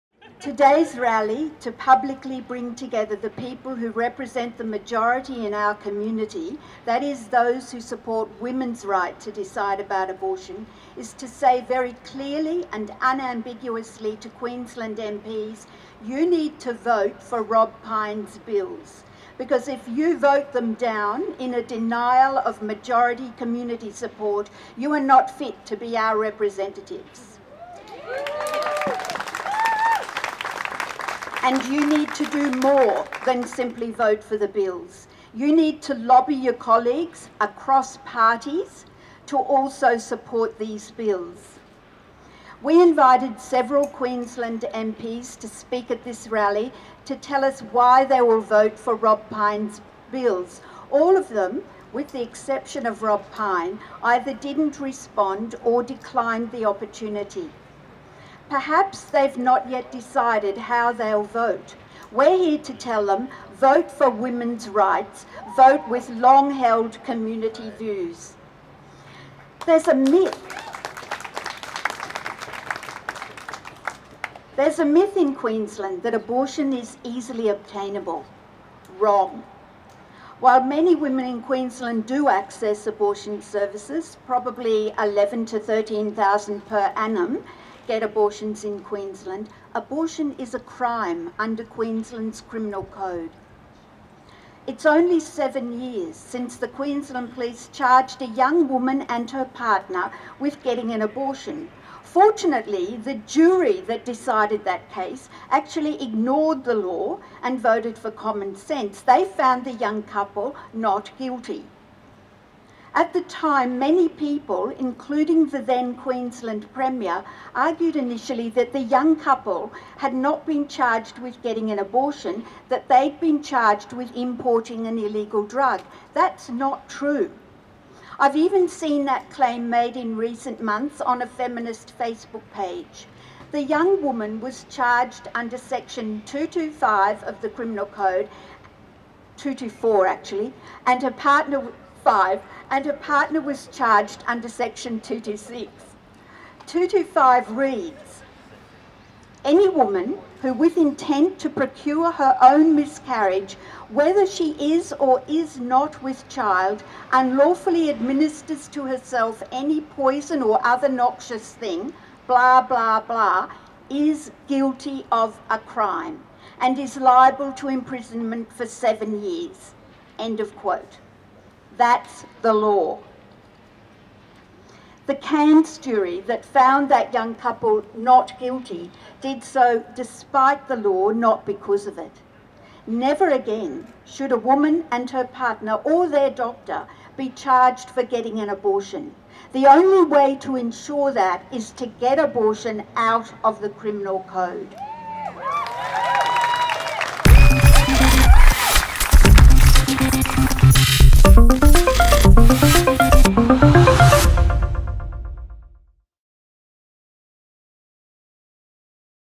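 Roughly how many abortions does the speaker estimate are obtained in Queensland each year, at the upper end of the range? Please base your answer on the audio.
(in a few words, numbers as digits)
13,000.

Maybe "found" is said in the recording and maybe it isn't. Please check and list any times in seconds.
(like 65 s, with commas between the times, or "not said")
109 s, 176 s.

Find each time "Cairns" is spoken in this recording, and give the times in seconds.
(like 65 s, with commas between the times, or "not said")
175 s.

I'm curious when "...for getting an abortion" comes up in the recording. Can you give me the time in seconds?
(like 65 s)
187 s.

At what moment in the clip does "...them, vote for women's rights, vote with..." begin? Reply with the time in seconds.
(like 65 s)
63 s.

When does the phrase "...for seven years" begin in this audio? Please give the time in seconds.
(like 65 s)
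168 s.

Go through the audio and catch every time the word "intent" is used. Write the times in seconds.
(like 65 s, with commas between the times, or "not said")
150 s.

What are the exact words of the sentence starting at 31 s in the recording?
And you need to do more than simply vote for the bills.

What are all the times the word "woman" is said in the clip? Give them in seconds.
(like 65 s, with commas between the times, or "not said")
98 s, 134 s, 149 s, 184 s.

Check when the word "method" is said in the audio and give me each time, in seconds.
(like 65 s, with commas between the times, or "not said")
not said.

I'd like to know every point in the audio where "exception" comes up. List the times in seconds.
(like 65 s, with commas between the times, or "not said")
52 s.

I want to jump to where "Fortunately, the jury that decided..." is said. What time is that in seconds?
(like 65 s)
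102 s.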